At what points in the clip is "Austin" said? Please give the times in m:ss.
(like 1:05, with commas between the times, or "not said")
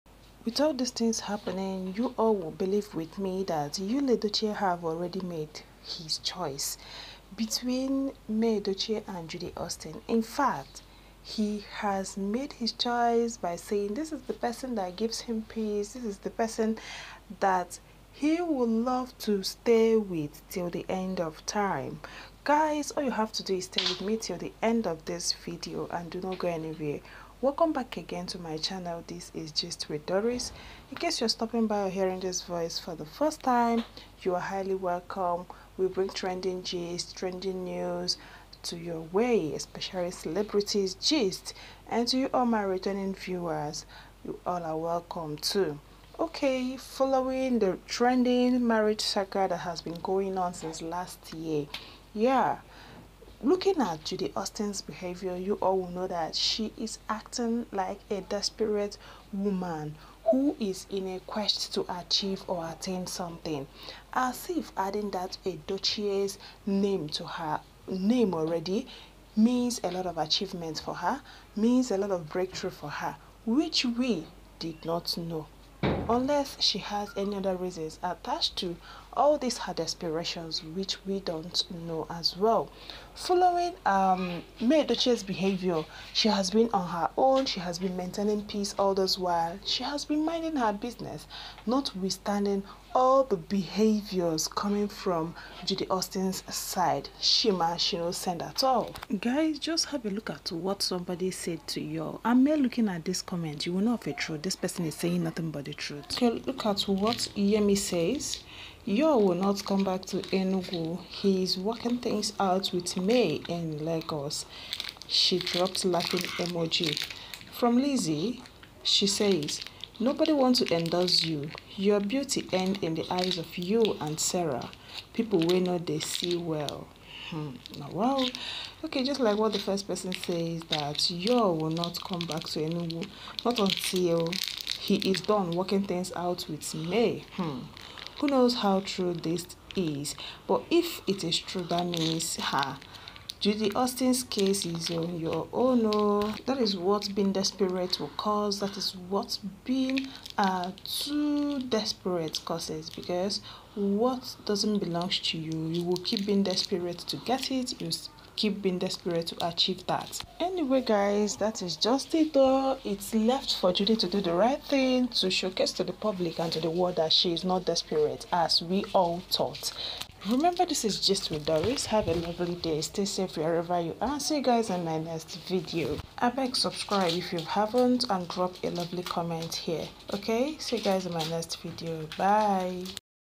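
0:09, 0:54, 1:35, 2:23.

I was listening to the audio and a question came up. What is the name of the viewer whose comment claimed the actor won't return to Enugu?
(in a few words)
Yemi.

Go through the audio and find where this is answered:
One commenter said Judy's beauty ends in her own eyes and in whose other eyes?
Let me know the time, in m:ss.
2:04.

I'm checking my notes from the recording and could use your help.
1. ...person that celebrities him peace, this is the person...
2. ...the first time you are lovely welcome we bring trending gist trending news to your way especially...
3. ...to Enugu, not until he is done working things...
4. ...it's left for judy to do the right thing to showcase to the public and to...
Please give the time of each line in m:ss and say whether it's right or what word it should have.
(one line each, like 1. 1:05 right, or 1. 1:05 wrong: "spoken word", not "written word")
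1. 0:14 wrong: "gives", not "celebrities"
2. 0:32 wrong: "highly", not "lovely"
3. 2:12 right
4. 2:42 right.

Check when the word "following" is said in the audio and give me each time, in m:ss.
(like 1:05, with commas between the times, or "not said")
0:46, 1:23.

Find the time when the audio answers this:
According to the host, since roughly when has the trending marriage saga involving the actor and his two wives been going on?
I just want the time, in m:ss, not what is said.
0:50.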